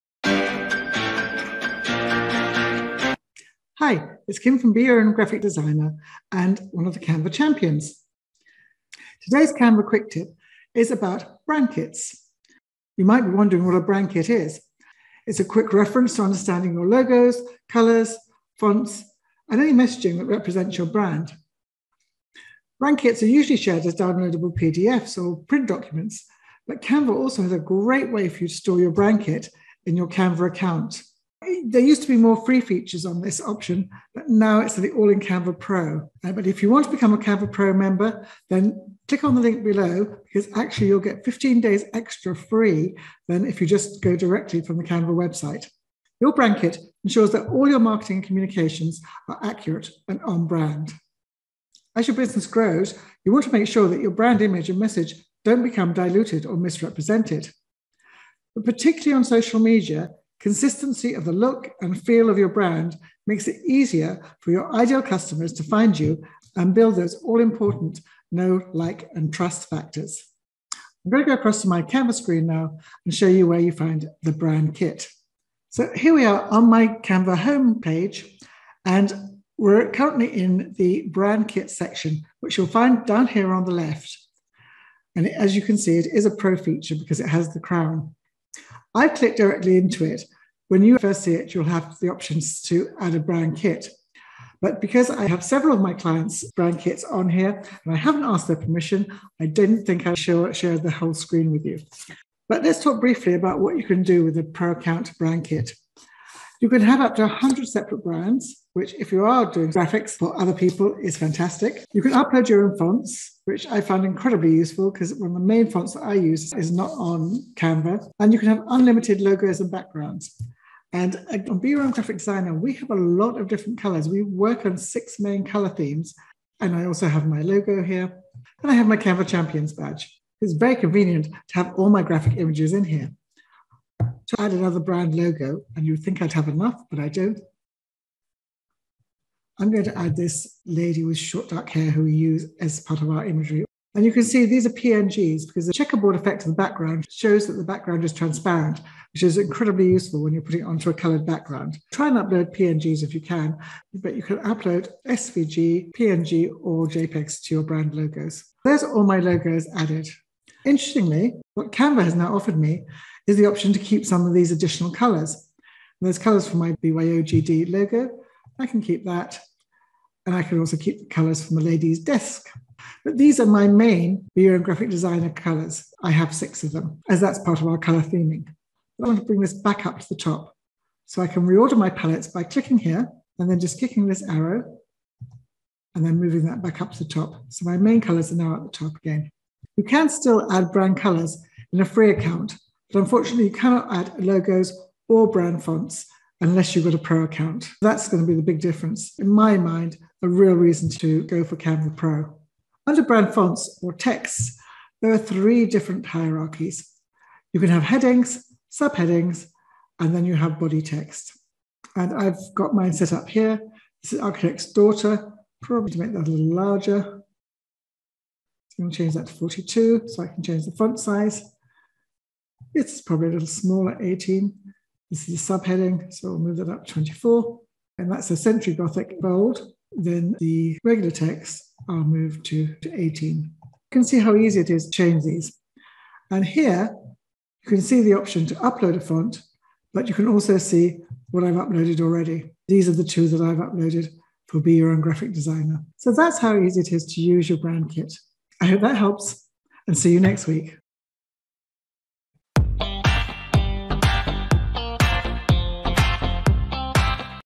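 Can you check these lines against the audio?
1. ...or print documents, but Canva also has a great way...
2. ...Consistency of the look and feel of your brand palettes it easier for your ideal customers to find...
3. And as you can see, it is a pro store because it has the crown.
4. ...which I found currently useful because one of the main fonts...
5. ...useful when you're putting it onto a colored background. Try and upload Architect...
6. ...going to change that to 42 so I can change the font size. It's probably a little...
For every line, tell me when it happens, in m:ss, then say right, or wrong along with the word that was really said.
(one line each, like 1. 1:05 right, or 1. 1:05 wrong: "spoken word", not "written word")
1. 0:25 right
2. 1:00 wrong: "makes", not "palettes"
3. 1:25 wrong: "feature", not "store"
4. 1:53 wrong: "incredibly", not "currently"
5. 2:29 wrong: "PNGs", not "Architect"
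6. 3:38 right.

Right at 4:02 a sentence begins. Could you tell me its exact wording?
These are the two that I've uploaded for Be Your Own Graphic Designer.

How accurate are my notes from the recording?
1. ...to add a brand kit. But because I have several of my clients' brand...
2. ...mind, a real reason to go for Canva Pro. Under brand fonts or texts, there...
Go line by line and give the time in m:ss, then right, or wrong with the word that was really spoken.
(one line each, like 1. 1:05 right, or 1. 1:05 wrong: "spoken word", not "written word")
1. 1:32 right
2. 3:19 right.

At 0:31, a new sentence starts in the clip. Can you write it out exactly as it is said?
There used to be more free features on this option, but now it's the All in Canva Pro.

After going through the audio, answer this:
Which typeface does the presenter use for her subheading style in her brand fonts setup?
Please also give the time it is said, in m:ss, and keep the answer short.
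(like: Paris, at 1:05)
Century Gothic Bold, at 3:48.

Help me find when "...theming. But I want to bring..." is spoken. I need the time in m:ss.
2:58.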